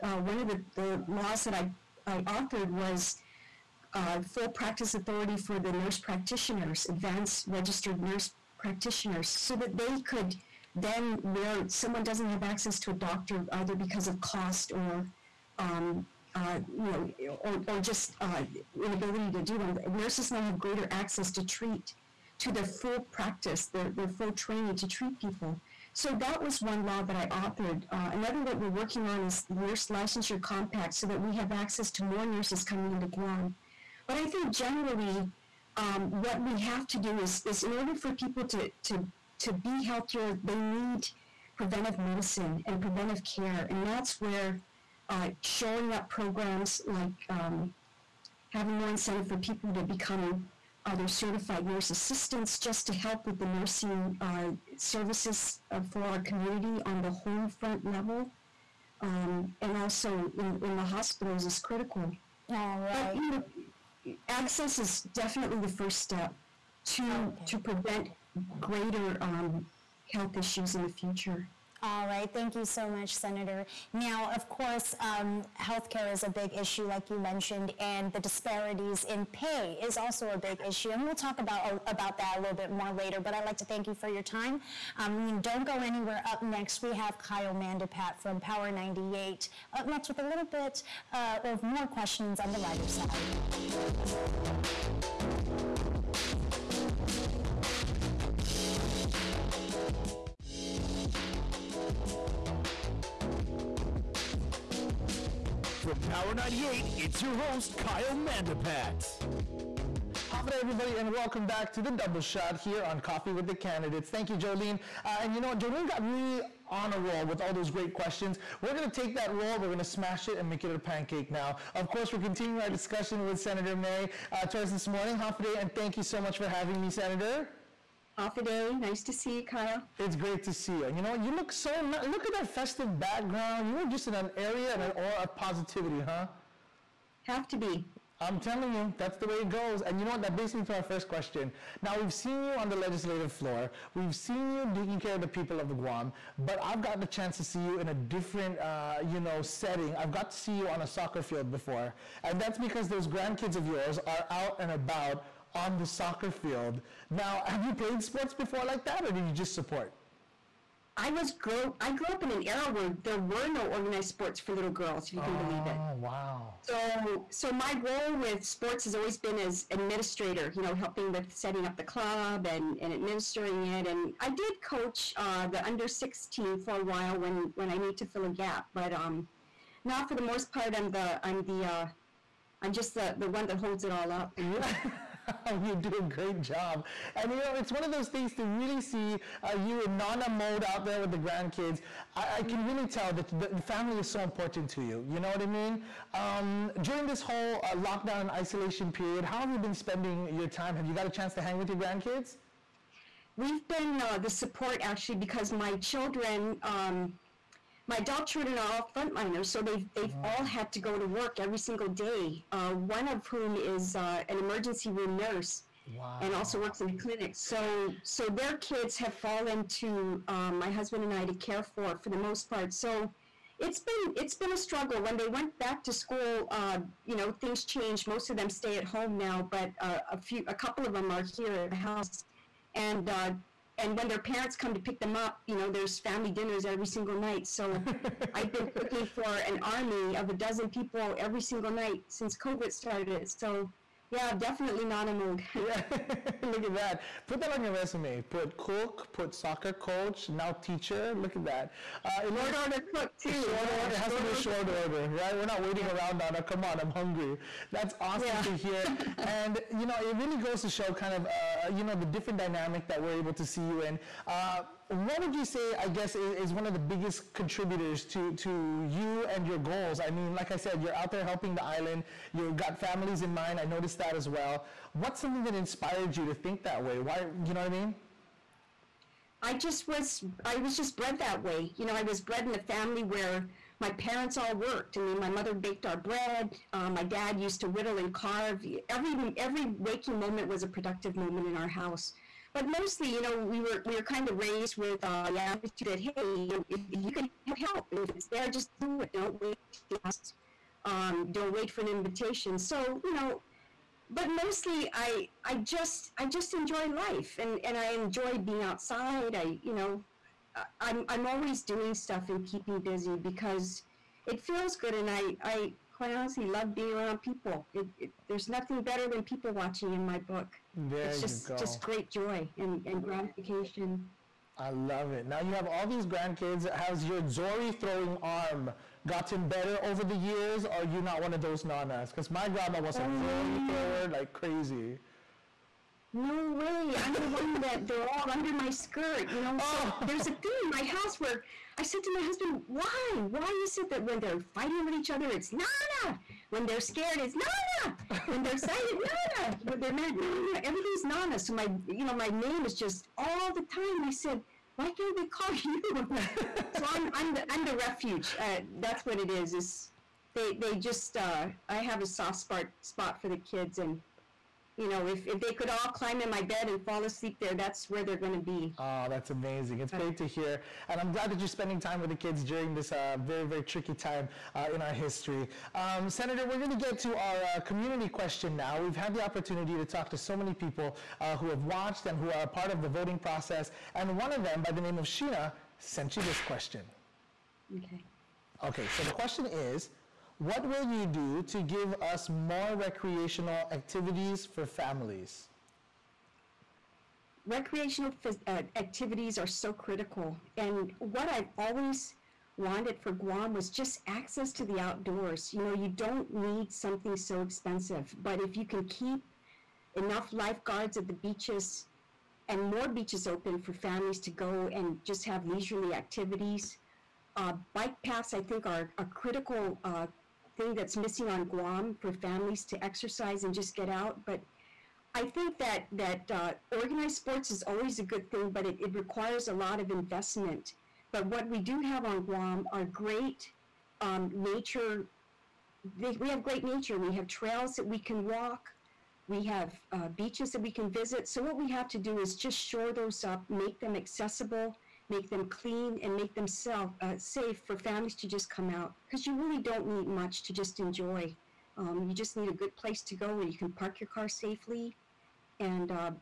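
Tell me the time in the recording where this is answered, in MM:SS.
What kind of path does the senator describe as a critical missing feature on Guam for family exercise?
06:57.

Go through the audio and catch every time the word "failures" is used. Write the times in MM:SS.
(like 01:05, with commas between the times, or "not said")
not said.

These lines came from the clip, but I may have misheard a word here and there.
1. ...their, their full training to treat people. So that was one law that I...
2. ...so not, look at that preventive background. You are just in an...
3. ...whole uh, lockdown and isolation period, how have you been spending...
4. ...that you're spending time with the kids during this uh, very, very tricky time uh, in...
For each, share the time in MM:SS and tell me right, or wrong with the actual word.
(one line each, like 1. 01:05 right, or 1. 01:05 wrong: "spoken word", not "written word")
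1. 00:23 right
2. 02:11 wrong: "festive", not "preventive"
3. 03:17 right
4. 06:11 right.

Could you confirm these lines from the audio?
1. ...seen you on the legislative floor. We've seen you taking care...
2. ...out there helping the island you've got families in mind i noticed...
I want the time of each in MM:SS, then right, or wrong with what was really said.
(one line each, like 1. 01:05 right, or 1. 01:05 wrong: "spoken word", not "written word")
1. 02:22 right
2. 04:30 right.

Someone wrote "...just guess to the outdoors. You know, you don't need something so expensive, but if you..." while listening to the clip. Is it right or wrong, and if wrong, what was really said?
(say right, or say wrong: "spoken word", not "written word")
wrong: "access", not "guess".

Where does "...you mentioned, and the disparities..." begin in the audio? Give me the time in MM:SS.
01:17.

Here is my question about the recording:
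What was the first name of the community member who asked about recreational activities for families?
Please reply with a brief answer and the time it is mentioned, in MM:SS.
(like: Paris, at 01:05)
Sheena, at 06:25.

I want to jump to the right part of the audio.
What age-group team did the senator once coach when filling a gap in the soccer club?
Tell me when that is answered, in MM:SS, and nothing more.
02:55.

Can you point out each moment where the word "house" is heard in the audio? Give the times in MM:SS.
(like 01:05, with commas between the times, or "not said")
03:51, 04:51, 05:40.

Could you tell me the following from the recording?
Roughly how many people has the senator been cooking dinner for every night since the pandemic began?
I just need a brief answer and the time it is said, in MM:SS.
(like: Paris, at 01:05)
12, at 04:00.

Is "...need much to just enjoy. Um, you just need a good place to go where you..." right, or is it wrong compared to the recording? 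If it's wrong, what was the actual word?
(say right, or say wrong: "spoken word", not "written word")
right.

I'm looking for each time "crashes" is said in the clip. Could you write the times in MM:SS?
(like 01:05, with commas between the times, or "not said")
not said.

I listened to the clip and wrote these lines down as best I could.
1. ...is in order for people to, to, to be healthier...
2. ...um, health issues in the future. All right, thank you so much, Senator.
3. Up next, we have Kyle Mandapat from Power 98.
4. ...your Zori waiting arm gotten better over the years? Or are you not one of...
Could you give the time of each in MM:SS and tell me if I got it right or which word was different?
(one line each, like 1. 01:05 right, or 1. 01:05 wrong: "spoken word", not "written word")
1. 00:37 right
2. 01:09 right
3. 01:26 right
4. 05:27 wrong: "throwing", not "waiting".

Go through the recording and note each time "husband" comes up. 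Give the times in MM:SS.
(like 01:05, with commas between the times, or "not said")
03:40, 05:42.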